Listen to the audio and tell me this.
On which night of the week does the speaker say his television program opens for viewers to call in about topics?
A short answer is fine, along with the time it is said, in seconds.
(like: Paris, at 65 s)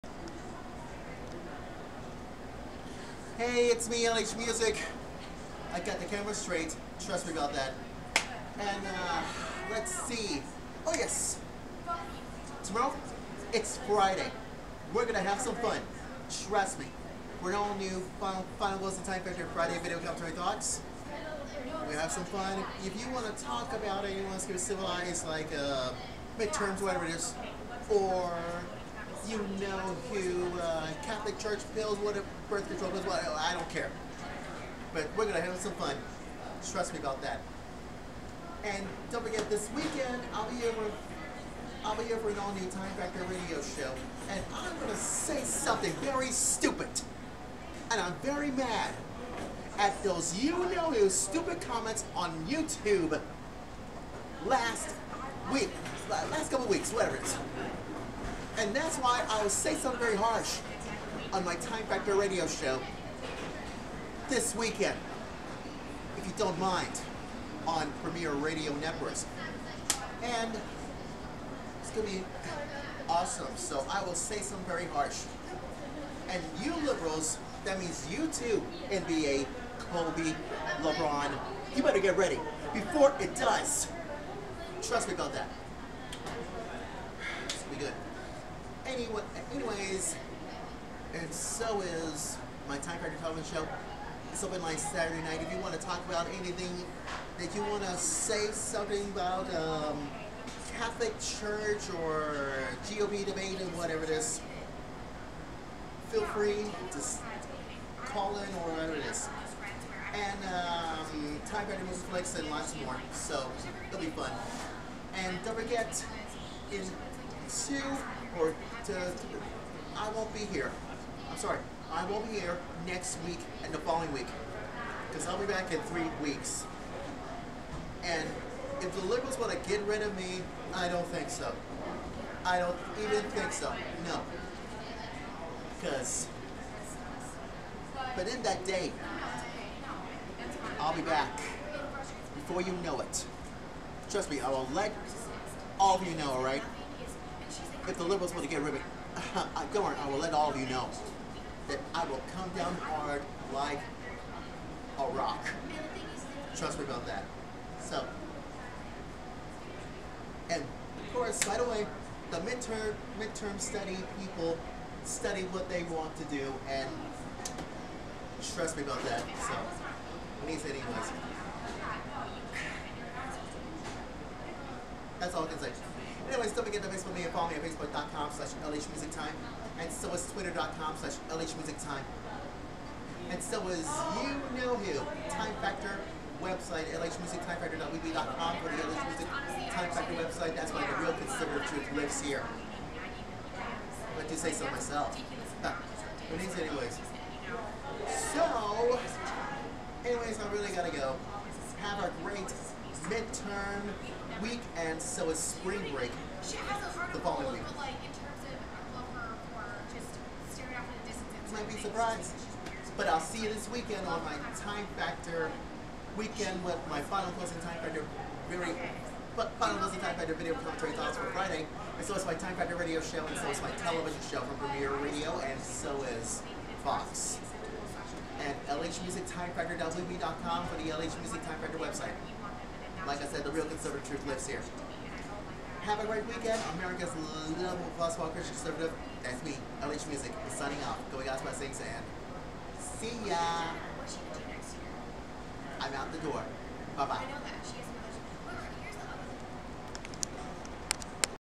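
Saturday night, at 94 s.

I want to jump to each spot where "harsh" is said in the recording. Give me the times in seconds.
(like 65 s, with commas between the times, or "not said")
60 s, 74 s.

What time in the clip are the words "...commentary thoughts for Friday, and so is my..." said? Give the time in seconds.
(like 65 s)
220 s.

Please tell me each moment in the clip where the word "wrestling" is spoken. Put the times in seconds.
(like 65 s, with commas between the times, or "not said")
not said.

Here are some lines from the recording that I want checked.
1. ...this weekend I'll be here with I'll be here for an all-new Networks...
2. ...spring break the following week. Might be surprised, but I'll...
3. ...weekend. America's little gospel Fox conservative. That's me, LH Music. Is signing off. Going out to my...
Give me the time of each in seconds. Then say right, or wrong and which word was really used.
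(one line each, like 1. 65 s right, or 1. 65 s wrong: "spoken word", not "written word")
1. 39 s wrong: "Time", not "Networks"
2. 205 s right
3. 236 s wrong: "Christian", not "Fox".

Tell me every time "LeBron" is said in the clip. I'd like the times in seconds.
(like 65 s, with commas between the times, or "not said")
80 s.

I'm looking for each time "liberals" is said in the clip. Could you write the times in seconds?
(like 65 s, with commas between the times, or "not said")
76 s, 129 s, 148 s.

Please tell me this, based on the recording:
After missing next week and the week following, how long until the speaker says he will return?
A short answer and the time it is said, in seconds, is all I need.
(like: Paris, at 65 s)
3 weeks, at 125 s.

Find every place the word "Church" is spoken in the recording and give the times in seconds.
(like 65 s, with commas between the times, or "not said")
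31 s, 101 s.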